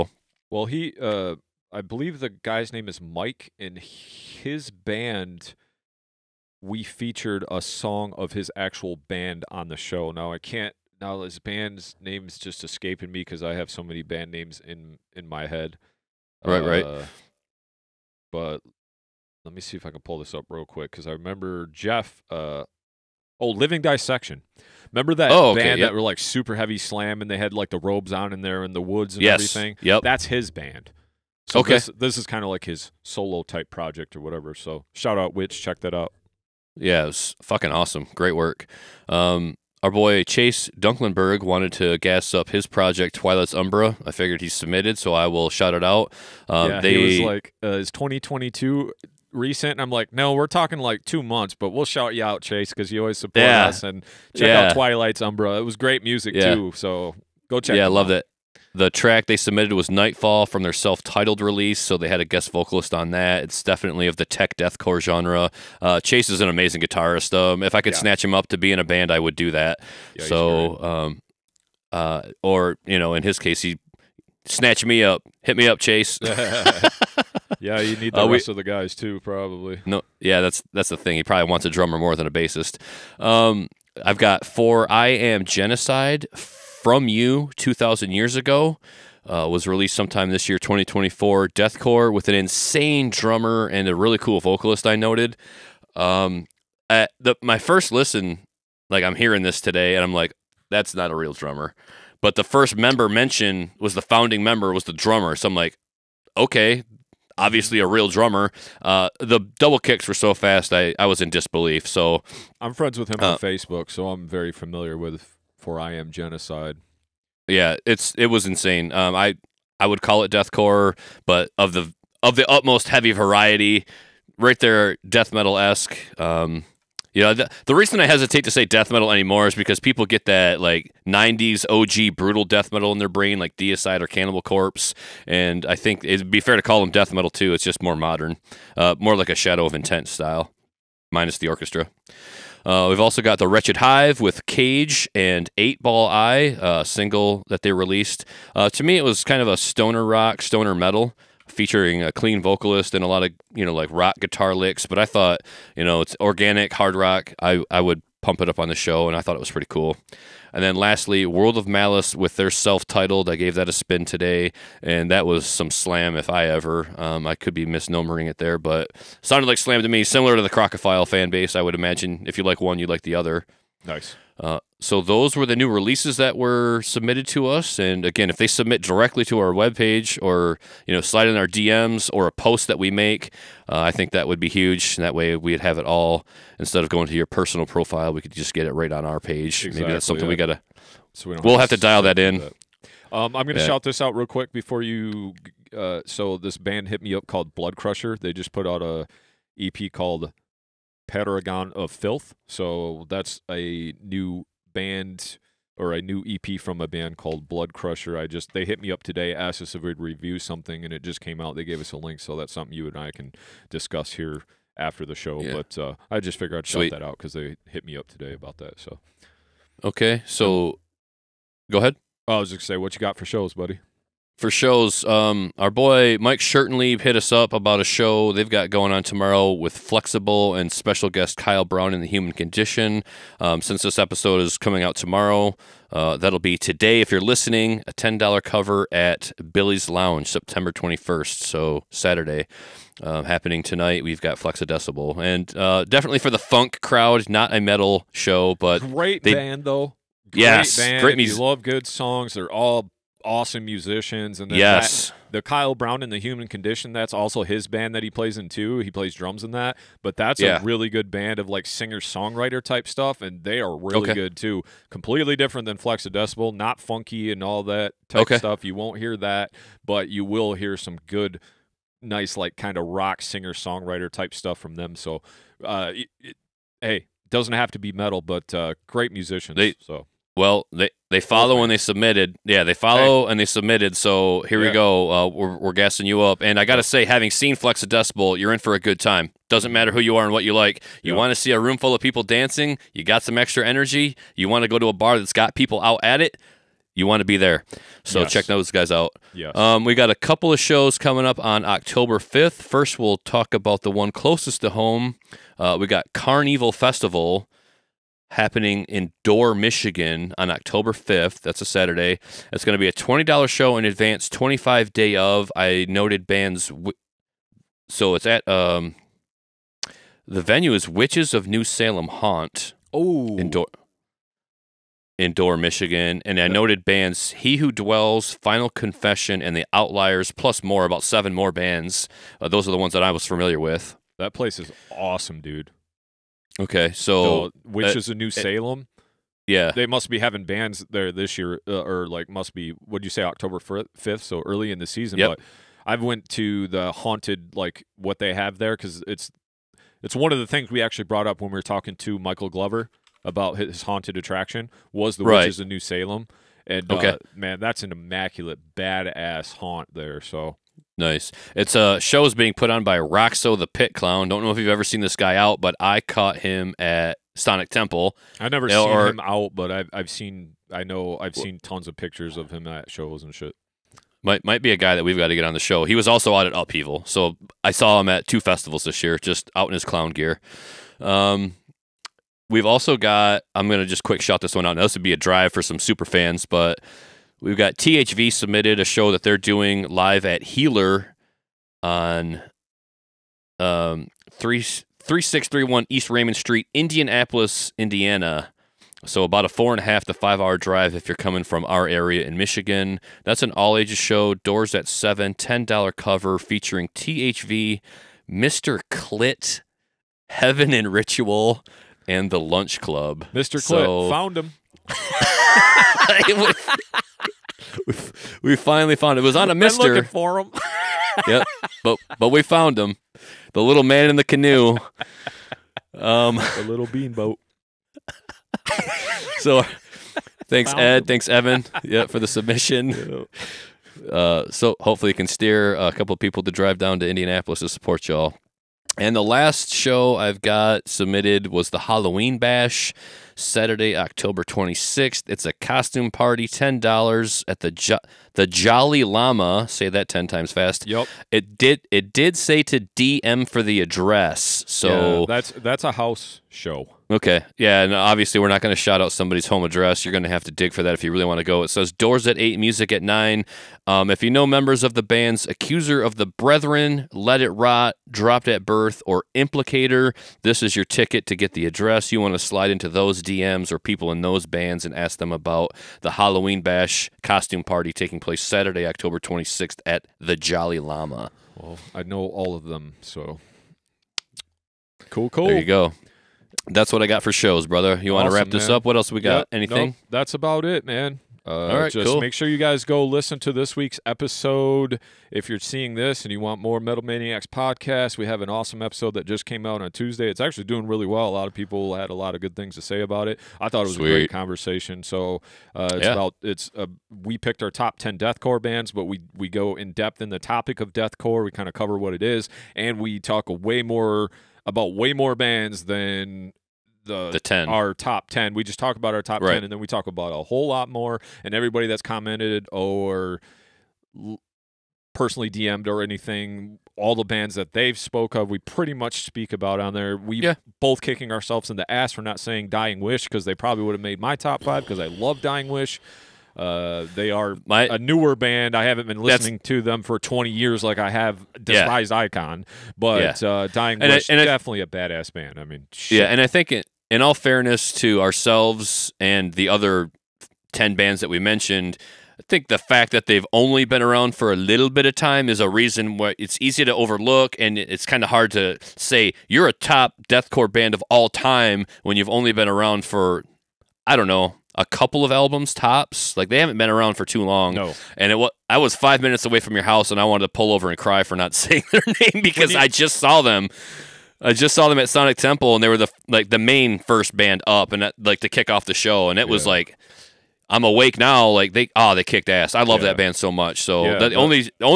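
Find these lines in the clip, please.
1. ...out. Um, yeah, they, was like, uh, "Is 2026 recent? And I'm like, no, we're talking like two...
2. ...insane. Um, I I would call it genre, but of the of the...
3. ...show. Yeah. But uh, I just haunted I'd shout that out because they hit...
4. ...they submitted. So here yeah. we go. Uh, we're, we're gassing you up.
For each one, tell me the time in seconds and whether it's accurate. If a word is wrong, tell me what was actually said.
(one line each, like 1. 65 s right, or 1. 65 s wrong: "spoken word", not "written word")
1. 45 s wrong: "2022", not "2026"
2. 118 s wrong: "deathcore", not "genre"
3. 215 s wrong: "figured", not "haunted"
4. 283 s right.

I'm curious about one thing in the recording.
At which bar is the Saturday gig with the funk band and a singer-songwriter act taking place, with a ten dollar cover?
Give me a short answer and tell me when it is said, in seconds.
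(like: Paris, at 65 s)
Billy's Lounge, at 239 s.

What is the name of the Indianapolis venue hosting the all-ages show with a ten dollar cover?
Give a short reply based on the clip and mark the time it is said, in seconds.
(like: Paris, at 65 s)
Healer, at 390 s.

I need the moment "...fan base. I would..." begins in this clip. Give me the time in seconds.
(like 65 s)
171 s.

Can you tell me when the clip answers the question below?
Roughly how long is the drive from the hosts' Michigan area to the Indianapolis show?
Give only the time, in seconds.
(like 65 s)
399 s.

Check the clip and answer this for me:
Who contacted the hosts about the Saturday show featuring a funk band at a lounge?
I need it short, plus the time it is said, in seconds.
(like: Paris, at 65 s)
Mike Shirtenlieb, at 226 s.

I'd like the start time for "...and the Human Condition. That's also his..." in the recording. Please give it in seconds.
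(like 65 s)
256 s.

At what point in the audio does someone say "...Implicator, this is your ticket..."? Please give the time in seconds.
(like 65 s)
469 s.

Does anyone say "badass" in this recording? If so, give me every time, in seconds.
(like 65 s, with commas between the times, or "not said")
358 s, 544 s.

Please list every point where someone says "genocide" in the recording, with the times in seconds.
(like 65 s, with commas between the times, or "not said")
85 s, 116 s.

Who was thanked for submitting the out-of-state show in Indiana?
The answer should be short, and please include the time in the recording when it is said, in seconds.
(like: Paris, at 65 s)
Evan, at 431 s.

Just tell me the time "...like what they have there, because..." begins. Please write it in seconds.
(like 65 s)
347 s.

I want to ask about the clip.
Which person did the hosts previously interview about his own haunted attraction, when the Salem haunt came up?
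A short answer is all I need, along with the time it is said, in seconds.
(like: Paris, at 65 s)
Michael Glover, at 352 s.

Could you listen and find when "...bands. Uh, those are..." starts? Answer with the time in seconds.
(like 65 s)
331 s.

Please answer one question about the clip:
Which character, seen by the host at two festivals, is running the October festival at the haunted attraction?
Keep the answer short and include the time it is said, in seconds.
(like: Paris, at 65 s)
Roxo the Pit Clown, at 362 s.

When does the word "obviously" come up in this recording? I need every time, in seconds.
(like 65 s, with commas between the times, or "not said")
107 s, 457 s.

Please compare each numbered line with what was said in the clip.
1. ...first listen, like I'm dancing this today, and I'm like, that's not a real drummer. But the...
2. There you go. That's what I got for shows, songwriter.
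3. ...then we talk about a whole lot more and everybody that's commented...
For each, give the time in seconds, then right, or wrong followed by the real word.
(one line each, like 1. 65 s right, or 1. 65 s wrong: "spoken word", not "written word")
1. 97 s wrong: "hearing", not "dancing"
2. 485 s wrong: "brother", not "songwriter"
3. 519 s right.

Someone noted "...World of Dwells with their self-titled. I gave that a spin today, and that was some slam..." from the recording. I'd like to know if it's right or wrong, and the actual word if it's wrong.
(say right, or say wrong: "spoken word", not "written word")
wrong: "Malice", not "Dwells".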